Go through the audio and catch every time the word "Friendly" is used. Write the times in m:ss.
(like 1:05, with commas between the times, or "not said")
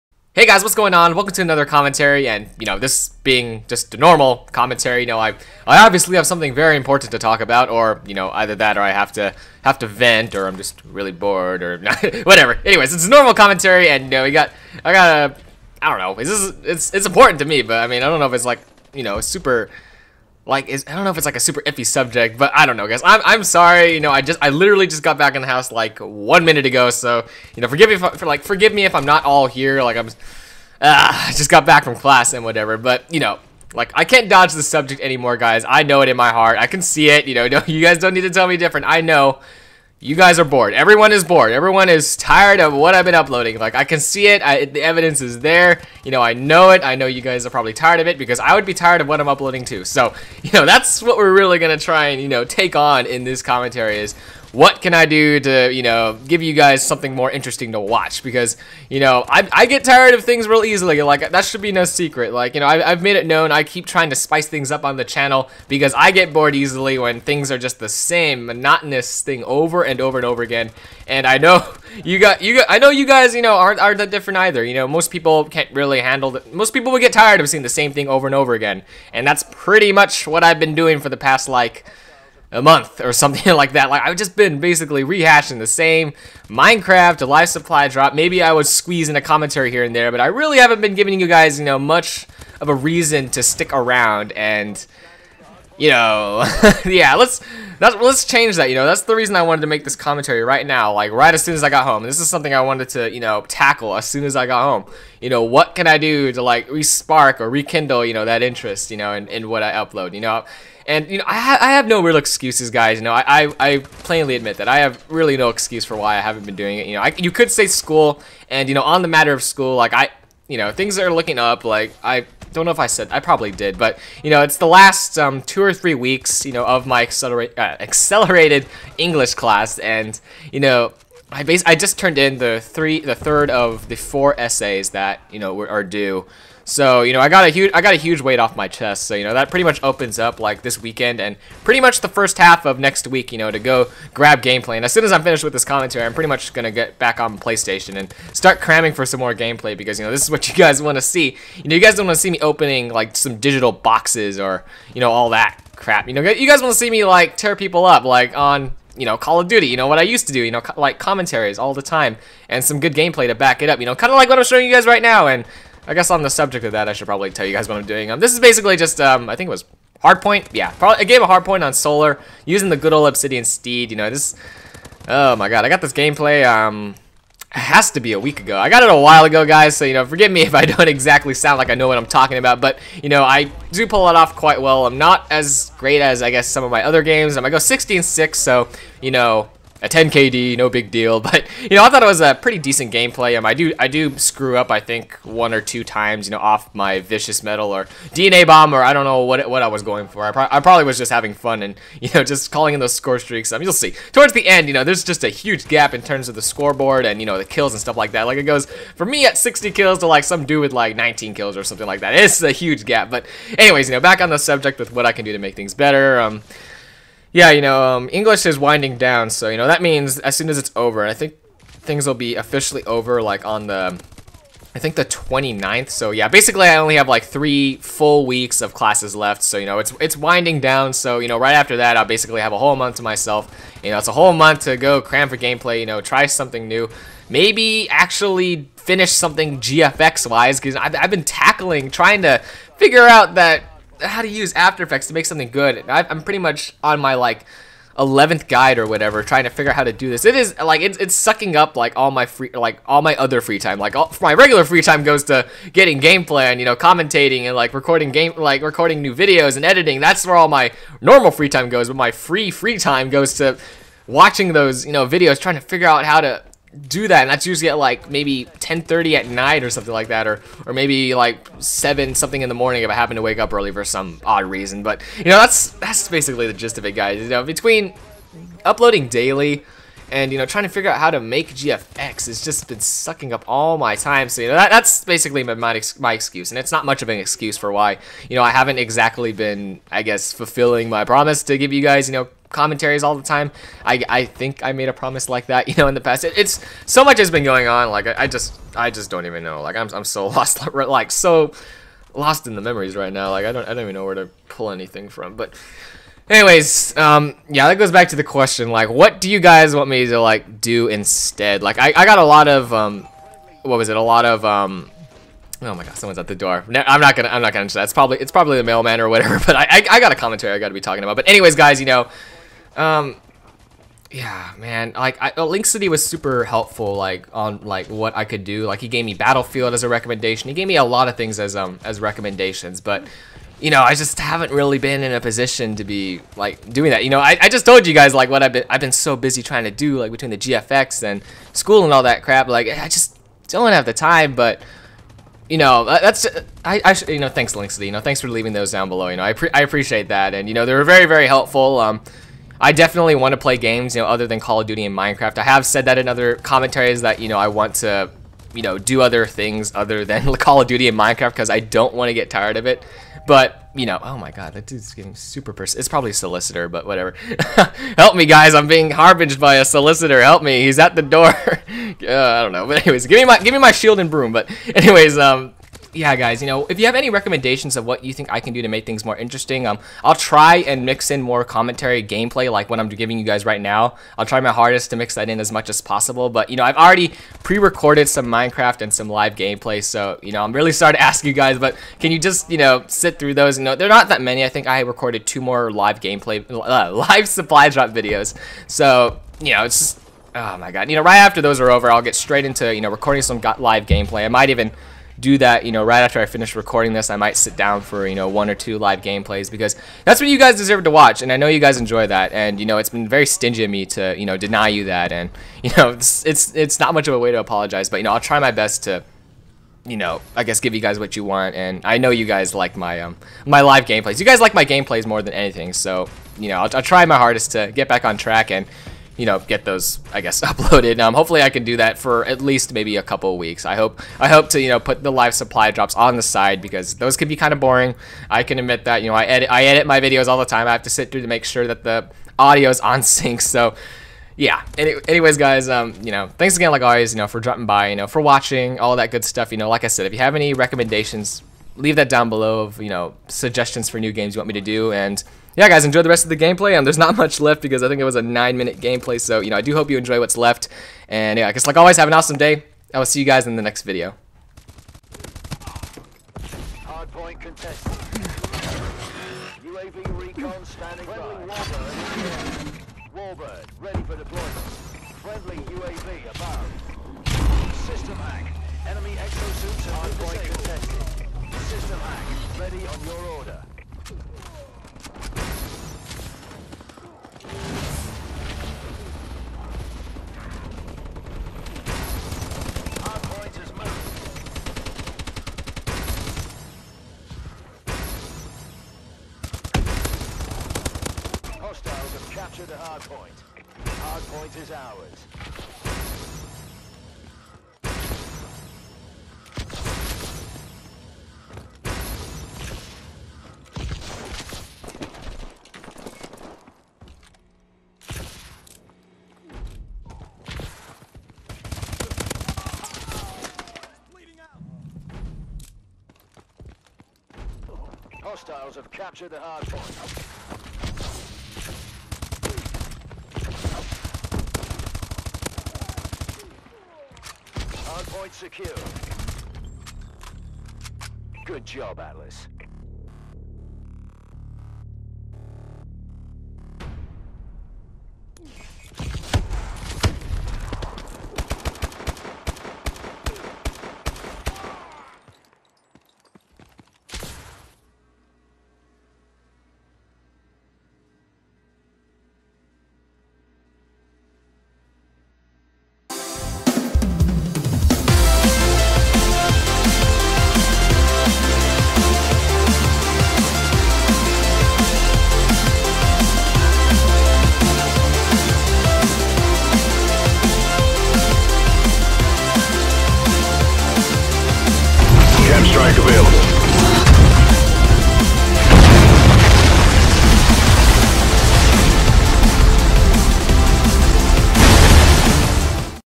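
7:55.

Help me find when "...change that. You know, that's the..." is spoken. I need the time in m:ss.
1:38.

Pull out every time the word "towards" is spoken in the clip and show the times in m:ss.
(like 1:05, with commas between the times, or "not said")
3:24.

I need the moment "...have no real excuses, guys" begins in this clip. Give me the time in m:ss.
1:51.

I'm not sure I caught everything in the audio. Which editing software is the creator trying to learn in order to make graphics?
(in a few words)
After Effects.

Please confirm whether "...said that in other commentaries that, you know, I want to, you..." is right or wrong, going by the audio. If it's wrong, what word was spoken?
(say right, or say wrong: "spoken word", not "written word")
right.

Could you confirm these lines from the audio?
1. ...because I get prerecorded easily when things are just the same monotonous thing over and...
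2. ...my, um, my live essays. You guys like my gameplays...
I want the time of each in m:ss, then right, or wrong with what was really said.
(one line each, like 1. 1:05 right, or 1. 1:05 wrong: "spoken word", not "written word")
1. 1:05 wrong: "bored", not "prerecorded"
2. 7:02 wrong: "gameplays", not "essays".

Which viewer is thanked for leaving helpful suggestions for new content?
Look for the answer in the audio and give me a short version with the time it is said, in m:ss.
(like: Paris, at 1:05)
Link City, at 5:25.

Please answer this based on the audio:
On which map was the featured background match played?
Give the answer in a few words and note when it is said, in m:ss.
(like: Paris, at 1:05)
Solar, at 2:51.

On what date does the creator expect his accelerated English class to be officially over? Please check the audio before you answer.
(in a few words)
the 29th.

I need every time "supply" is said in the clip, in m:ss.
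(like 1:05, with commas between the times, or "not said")
1:27, 6:37, 7:15.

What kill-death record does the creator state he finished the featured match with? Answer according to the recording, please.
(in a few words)
16-6.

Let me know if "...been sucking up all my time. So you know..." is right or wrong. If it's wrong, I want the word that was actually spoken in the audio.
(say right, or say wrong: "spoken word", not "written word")
right.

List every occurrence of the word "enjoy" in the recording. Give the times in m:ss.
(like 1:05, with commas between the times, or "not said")
6:51, 7:35, 7:39.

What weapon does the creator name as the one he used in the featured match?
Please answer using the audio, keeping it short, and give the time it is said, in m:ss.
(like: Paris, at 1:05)
Obsidian Steed, at 2:53.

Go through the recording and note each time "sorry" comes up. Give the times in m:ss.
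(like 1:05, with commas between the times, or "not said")
0:23, 6:30.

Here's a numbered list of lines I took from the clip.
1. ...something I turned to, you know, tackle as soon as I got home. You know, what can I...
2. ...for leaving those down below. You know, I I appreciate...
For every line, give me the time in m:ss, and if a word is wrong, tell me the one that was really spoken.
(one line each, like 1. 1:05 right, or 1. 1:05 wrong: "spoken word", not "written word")
1. 1:42 wrong: "wanted", not "turned"
2. 5:48 right.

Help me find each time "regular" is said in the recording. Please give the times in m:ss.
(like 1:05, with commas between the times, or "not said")
4:14.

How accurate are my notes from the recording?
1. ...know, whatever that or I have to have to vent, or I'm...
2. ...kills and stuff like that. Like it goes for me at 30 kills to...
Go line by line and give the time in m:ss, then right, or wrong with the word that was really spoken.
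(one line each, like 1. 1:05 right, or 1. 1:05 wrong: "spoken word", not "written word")
1. 0:08 wrong: "either", not "whatever"
2. 3:27 wrong: "60", not "30".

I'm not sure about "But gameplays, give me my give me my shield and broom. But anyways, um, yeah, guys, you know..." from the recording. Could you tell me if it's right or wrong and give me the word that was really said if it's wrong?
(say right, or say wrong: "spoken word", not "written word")
wrong: "anyways", not "gameplays".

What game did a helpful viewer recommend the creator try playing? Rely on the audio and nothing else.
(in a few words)
Battlefield.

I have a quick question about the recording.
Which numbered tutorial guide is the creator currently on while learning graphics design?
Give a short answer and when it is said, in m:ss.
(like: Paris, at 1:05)
11th, at 4:07.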